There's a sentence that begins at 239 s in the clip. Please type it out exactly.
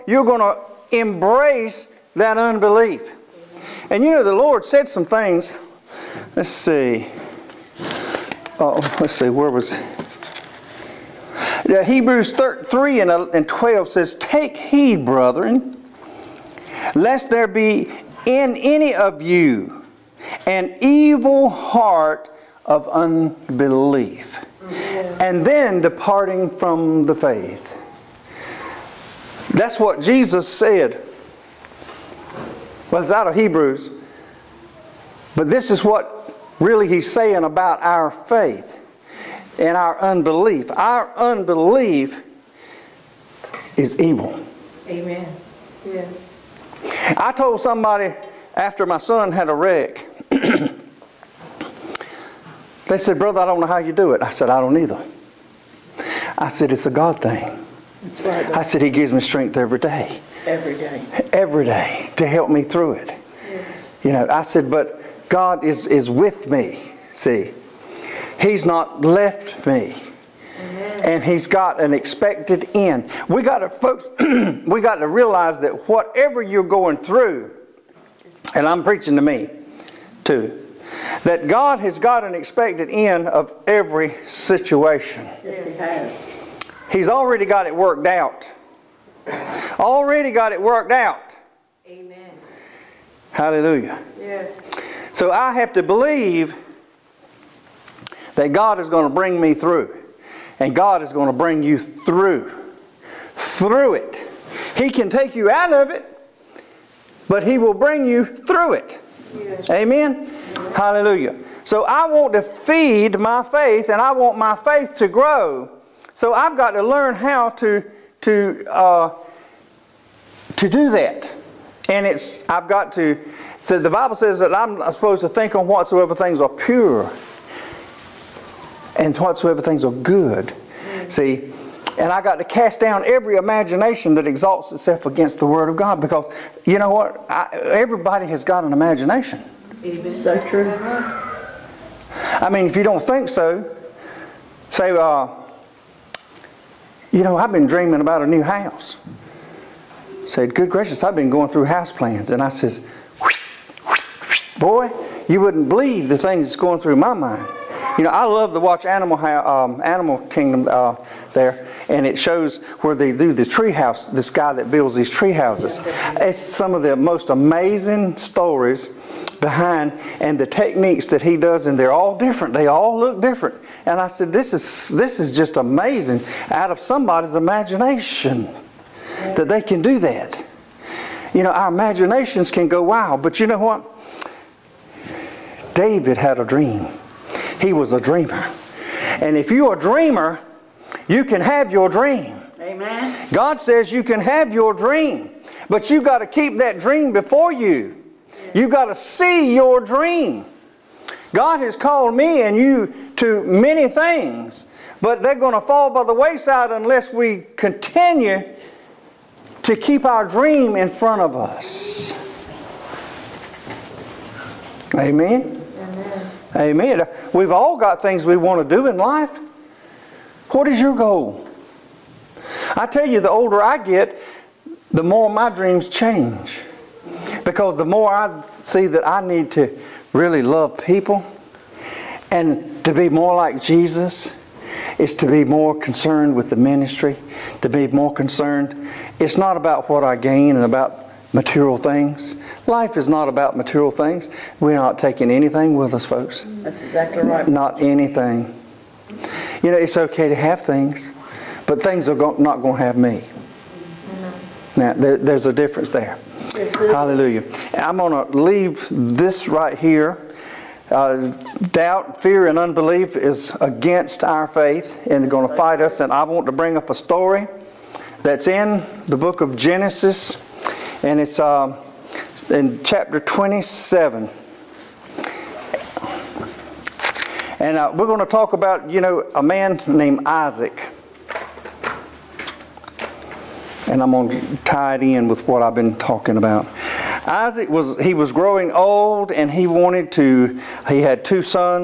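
It's not about what I gain and about material things.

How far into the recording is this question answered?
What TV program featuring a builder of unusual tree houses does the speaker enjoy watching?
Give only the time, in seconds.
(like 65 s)
159 s.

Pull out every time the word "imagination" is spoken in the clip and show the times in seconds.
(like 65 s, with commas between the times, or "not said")
133 s, 138 s, 177 s, 181 s.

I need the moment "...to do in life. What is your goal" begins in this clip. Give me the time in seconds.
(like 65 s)
218 s.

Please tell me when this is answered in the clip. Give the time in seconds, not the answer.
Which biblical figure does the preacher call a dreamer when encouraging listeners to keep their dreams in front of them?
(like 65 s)
185 s.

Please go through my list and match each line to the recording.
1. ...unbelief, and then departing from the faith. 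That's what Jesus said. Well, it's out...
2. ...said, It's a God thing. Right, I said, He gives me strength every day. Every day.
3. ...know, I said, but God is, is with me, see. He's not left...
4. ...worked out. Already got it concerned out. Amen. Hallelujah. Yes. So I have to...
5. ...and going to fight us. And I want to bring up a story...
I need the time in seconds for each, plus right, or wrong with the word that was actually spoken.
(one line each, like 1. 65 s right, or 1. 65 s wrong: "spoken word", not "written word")
1. 22 s right
2. 56 s right
3. 64 s right
4. 87 s wrong: "worked", not "concerned"
5. 265 s right.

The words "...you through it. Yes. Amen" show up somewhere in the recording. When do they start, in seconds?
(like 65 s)
108 s.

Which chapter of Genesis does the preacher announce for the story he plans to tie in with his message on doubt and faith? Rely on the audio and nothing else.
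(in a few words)
27.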